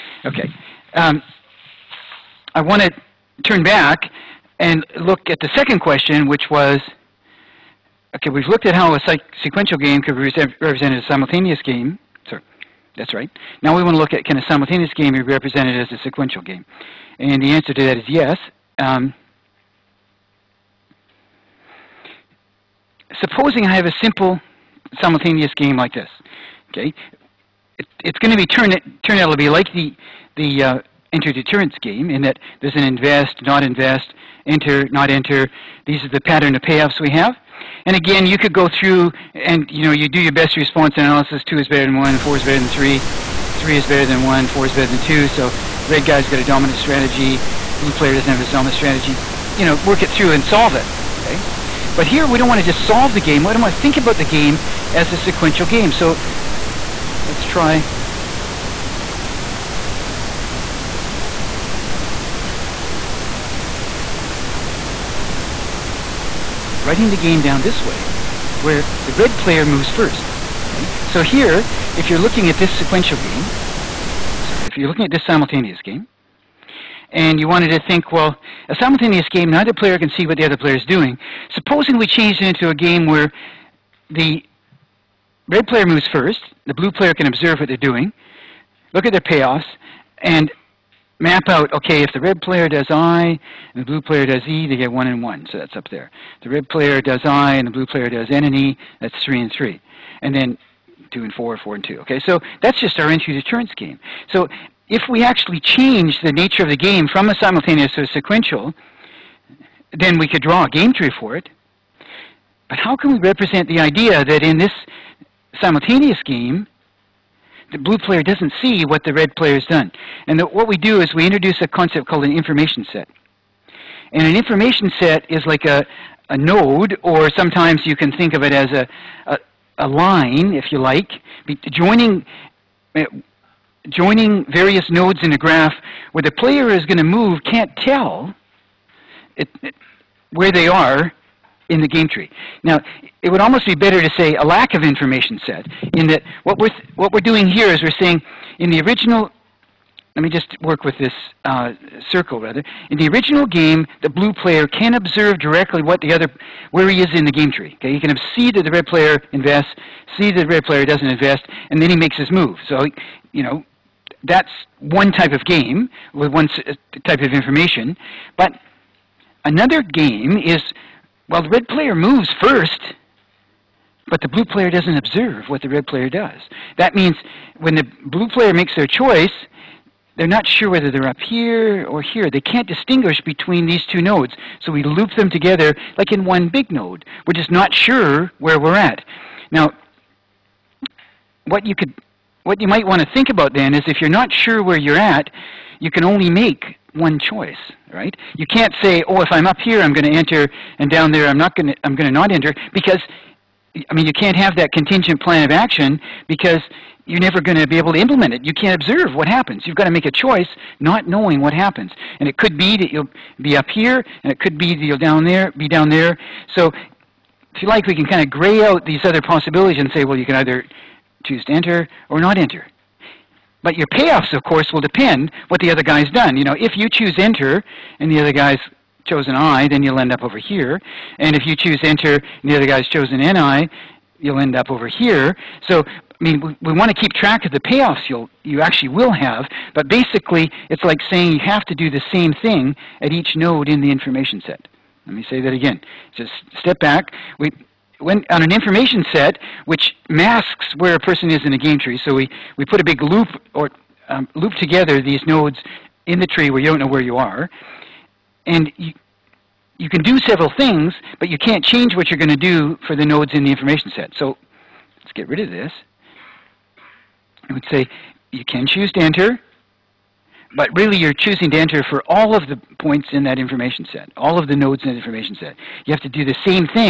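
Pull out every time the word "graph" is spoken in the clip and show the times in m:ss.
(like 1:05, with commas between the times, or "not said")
2:15.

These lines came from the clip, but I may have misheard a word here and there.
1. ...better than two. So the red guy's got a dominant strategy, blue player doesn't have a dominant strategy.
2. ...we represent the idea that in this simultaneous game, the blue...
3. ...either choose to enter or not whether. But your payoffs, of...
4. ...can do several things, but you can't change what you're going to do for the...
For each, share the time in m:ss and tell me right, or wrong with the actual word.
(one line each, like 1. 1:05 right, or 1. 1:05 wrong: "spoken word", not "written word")
1. 0:44 right
2. 1:53 right
3. 3:40 wrong: "enter", not "whether"
4. 4:19 right.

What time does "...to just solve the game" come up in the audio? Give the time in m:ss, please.
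0:52.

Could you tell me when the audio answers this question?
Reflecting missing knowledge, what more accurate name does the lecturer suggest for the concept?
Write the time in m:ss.
2:24.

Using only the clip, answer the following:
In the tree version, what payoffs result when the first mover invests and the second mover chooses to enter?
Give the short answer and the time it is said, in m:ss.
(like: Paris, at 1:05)
1 and 1, at 1:34.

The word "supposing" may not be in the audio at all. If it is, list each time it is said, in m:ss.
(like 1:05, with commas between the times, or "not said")
0:23, 1:21.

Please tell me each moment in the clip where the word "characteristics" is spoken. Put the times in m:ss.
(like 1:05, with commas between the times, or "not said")
not said.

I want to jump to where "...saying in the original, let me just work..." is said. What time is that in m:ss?
2:28.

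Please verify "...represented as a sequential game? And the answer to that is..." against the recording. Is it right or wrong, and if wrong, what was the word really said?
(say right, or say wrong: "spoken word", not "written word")
right.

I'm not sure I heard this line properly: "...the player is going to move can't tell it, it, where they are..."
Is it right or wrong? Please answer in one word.
right.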